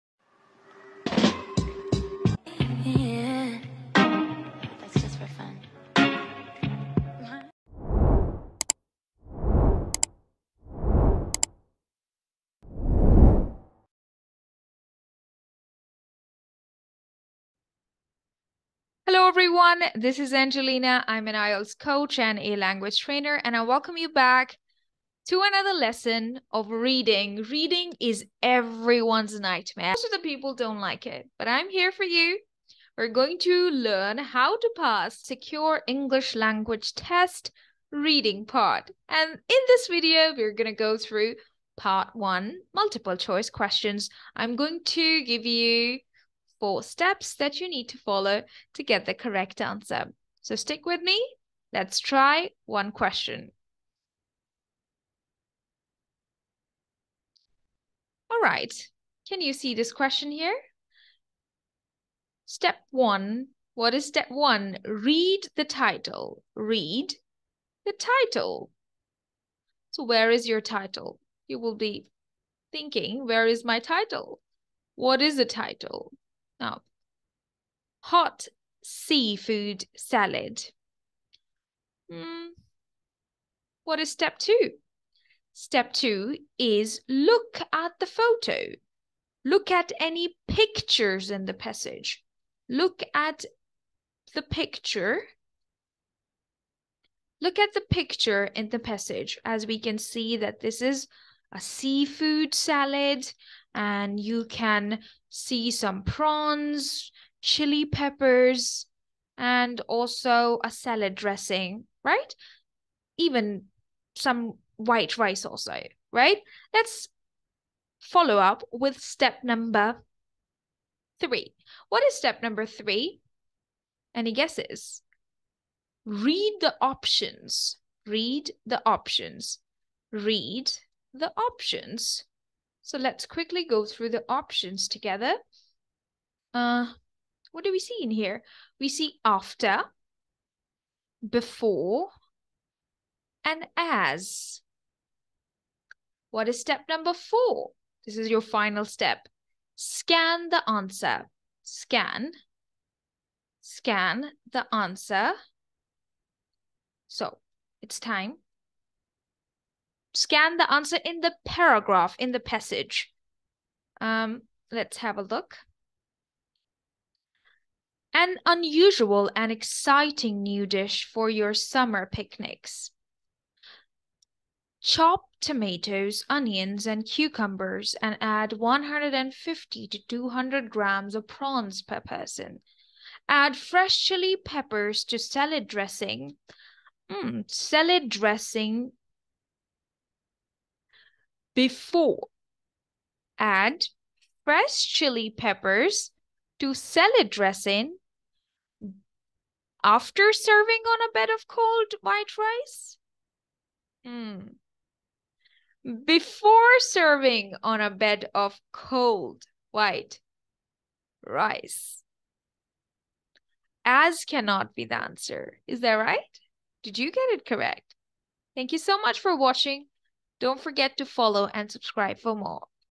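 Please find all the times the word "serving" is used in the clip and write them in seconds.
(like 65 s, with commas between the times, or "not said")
200 s, 206 s.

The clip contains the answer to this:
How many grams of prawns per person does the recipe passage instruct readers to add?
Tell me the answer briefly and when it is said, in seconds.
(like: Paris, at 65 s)
150 to 200 grams, at 178 s.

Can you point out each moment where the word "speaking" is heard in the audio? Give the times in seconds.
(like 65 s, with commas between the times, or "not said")
not said.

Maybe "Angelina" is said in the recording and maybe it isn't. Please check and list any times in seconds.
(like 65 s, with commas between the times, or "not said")
20 s.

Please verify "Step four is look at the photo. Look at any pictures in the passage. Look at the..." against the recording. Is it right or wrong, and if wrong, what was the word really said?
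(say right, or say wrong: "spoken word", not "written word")
wrong: "two", not "four".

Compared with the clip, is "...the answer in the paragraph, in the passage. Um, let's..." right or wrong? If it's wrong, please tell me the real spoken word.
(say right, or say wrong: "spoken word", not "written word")
right.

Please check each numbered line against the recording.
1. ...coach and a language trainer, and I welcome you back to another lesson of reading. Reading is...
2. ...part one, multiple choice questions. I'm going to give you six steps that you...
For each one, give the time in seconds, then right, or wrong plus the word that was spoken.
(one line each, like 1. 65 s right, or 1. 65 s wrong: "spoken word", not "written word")
1. 21 s right
2. 41 s wrong: "four", not "six".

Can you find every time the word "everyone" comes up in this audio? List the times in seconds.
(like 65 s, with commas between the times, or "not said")
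19 s, 28 s.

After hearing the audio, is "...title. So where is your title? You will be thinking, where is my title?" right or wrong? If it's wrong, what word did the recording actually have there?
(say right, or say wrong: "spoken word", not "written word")
right.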